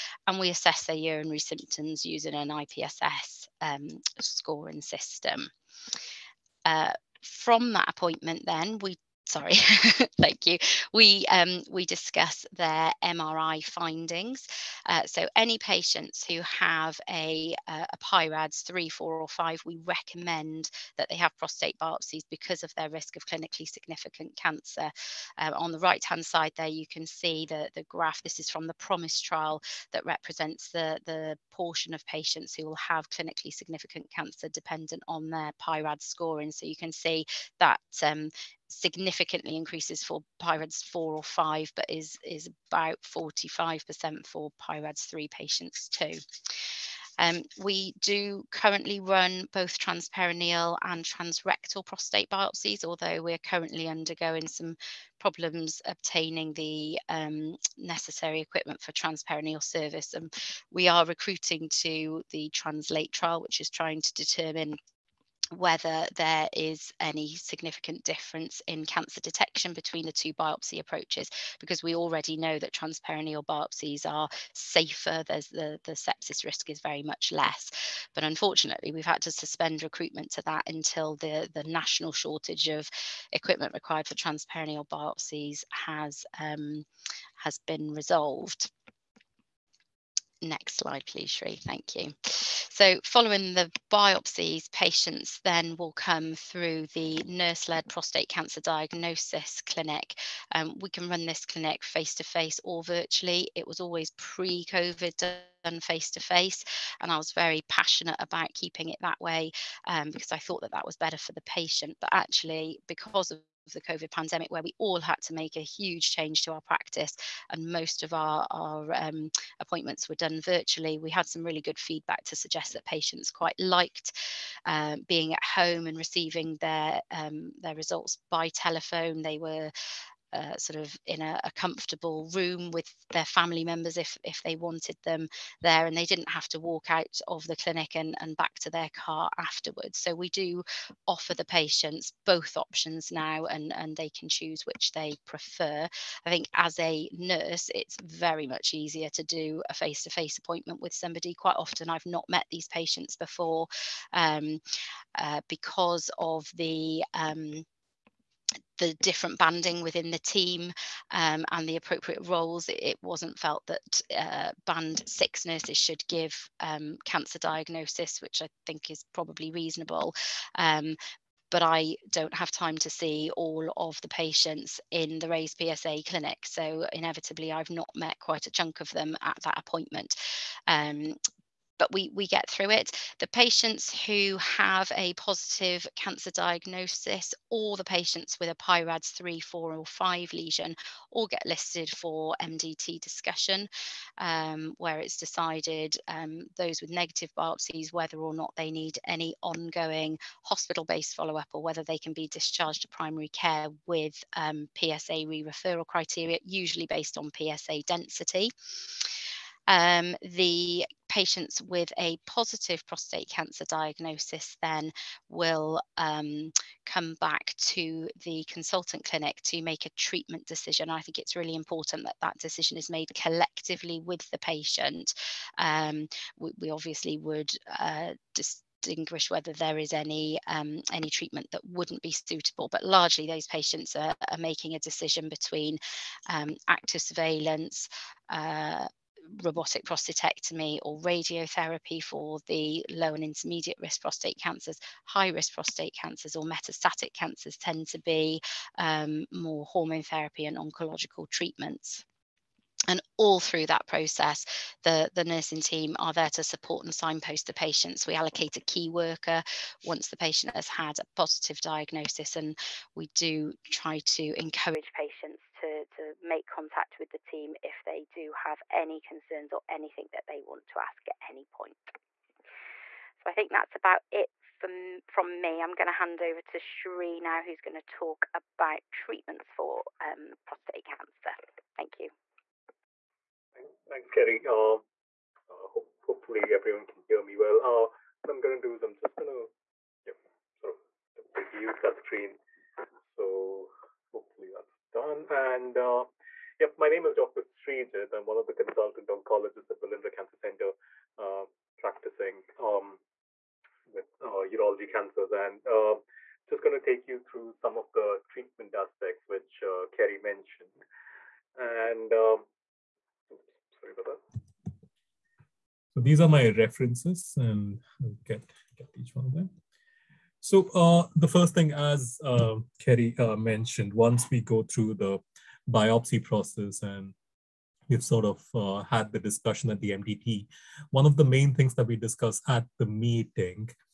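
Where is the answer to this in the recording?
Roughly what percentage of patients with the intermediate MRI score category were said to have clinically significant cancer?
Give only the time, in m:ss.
0:43.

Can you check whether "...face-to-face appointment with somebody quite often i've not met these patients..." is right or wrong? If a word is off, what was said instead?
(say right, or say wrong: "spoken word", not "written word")
right.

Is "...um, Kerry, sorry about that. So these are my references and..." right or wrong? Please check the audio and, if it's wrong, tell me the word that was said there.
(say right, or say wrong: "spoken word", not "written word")
wrong: "Oops", not "Kerry".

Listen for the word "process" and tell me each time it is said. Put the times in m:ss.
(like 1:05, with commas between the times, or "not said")
4:13, 5:26.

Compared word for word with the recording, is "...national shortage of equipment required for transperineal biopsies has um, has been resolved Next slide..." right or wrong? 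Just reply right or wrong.
right.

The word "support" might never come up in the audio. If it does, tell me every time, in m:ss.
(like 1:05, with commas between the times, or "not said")
4:16.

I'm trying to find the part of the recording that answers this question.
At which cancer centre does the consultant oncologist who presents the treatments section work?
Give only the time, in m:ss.
4:59.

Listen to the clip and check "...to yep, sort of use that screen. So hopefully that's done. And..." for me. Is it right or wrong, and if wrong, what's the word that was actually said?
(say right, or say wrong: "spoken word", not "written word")
right.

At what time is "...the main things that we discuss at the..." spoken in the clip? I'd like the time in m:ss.
5:31.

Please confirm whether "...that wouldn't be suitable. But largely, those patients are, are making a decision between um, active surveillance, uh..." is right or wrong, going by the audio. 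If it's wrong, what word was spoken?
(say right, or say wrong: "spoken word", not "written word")
right.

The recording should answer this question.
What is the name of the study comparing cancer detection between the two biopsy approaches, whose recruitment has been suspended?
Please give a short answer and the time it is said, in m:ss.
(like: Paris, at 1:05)
Translate, at 1:02.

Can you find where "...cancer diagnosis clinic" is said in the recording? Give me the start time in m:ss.
1:38.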